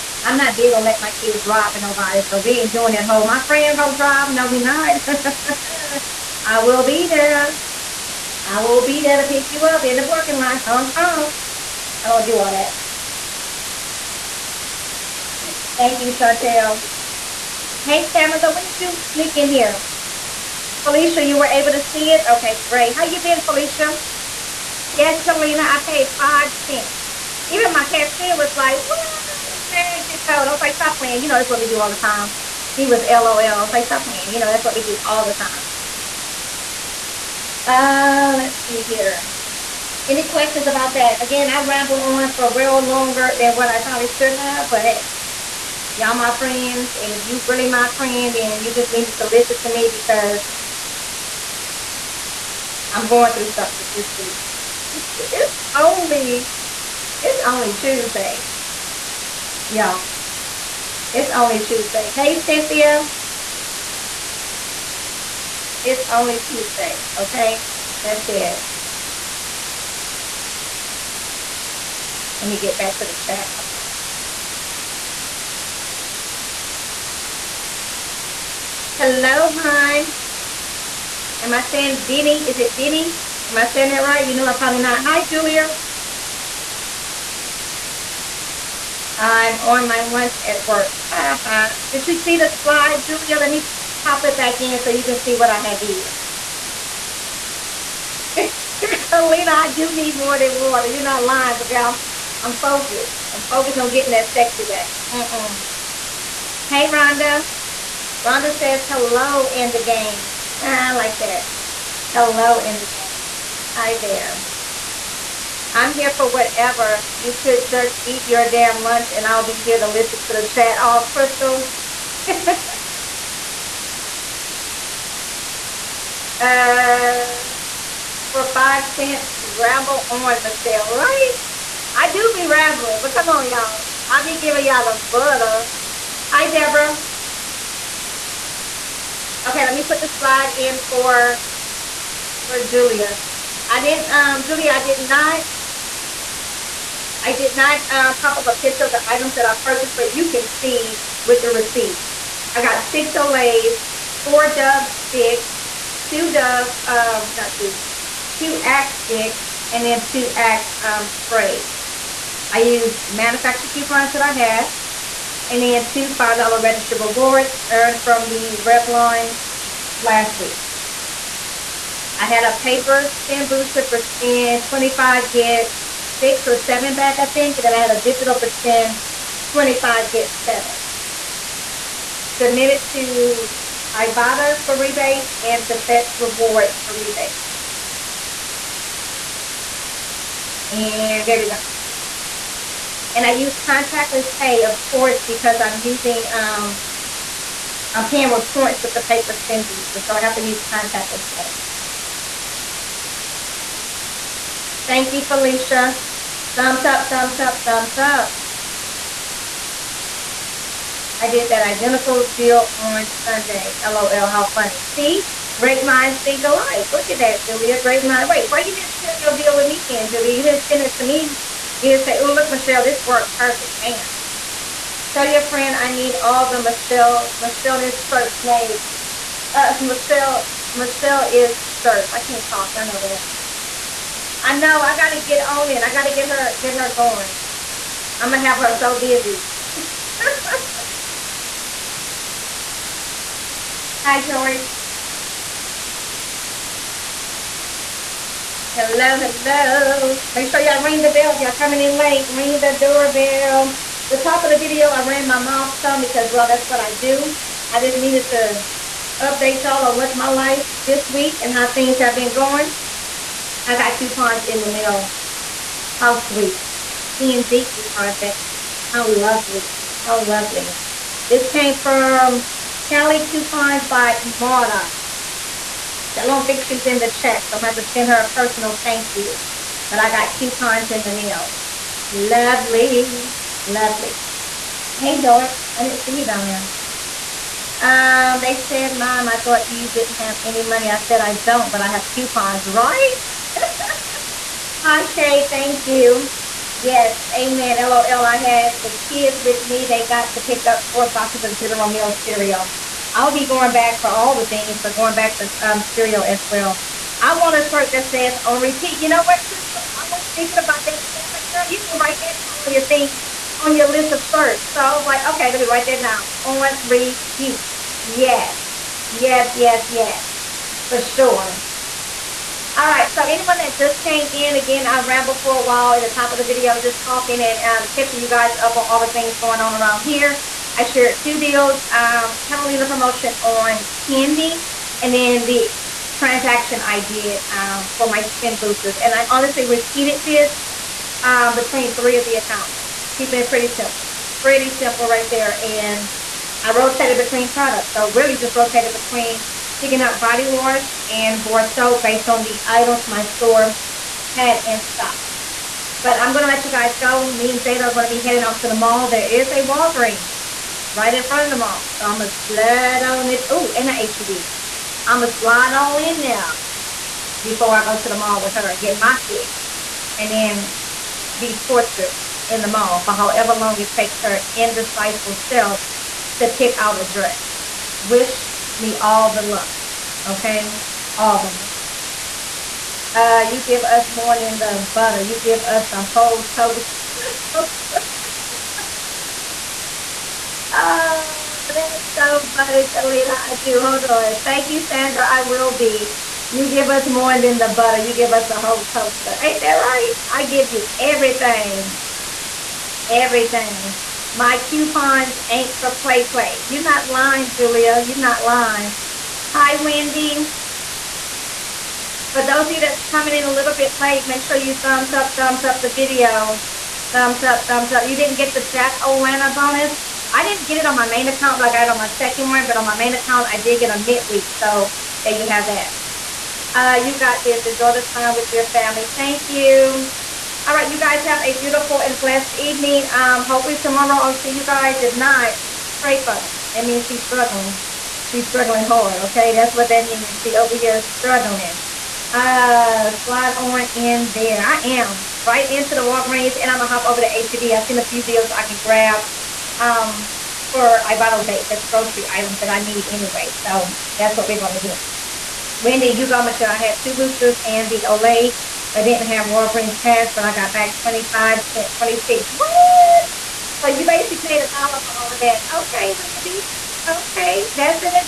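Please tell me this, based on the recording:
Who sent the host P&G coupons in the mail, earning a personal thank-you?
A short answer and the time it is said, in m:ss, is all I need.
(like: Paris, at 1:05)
Kelly Coupons by Marta, at 4:32.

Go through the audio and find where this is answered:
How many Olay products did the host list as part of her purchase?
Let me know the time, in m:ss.
2:32.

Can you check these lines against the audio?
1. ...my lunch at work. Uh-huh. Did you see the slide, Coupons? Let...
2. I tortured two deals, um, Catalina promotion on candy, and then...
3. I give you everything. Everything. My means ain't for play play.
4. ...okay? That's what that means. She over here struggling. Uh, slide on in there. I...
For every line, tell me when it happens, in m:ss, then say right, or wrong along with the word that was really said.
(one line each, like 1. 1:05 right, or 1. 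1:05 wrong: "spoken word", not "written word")
1. 1:29 wrong: "Julia", not "Coupons"
2. 5:30 wrong: "shared", not "tortured"
3. 6:40 wrong: "coupons", not "means"
4. 7:19 right.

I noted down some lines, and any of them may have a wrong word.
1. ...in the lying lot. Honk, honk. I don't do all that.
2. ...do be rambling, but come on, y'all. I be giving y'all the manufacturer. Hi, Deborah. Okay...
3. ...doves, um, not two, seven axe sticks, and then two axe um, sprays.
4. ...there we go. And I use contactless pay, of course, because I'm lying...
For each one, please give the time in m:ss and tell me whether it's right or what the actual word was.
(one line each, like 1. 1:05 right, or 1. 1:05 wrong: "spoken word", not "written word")
1. 0:09 wrong: "parking", not "lying"
2. 2:12 wrong: "butter", not "manufacturer"
3. 2:36 wrong: "two", not "seven"
4. 3:11 wrong: "using", not "lying".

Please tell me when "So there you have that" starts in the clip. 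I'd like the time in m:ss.
7:04.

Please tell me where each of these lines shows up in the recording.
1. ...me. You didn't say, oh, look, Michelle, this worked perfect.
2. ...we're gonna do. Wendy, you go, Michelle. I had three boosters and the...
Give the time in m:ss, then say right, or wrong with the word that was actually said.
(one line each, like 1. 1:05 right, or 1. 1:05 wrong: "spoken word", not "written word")
1. 3:41 right
2. 7:34 wrong: "two", not "three".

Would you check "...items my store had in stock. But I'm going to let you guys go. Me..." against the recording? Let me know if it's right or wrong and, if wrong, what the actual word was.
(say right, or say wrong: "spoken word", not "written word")
right.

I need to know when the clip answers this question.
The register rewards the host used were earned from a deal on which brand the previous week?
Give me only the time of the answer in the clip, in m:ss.
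2:48.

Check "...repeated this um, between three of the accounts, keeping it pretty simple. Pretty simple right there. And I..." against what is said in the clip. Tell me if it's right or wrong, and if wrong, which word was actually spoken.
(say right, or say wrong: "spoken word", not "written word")
right.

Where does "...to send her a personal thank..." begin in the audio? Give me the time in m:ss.
4:37.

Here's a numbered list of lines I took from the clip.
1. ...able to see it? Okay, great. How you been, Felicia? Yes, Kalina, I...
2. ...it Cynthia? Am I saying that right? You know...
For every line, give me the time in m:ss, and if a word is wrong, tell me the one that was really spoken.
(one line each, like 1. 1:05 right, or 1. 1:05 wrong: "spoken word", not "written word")
1. 0:21 right
2. 1:22 wrong: "Denny", not "Cynthia".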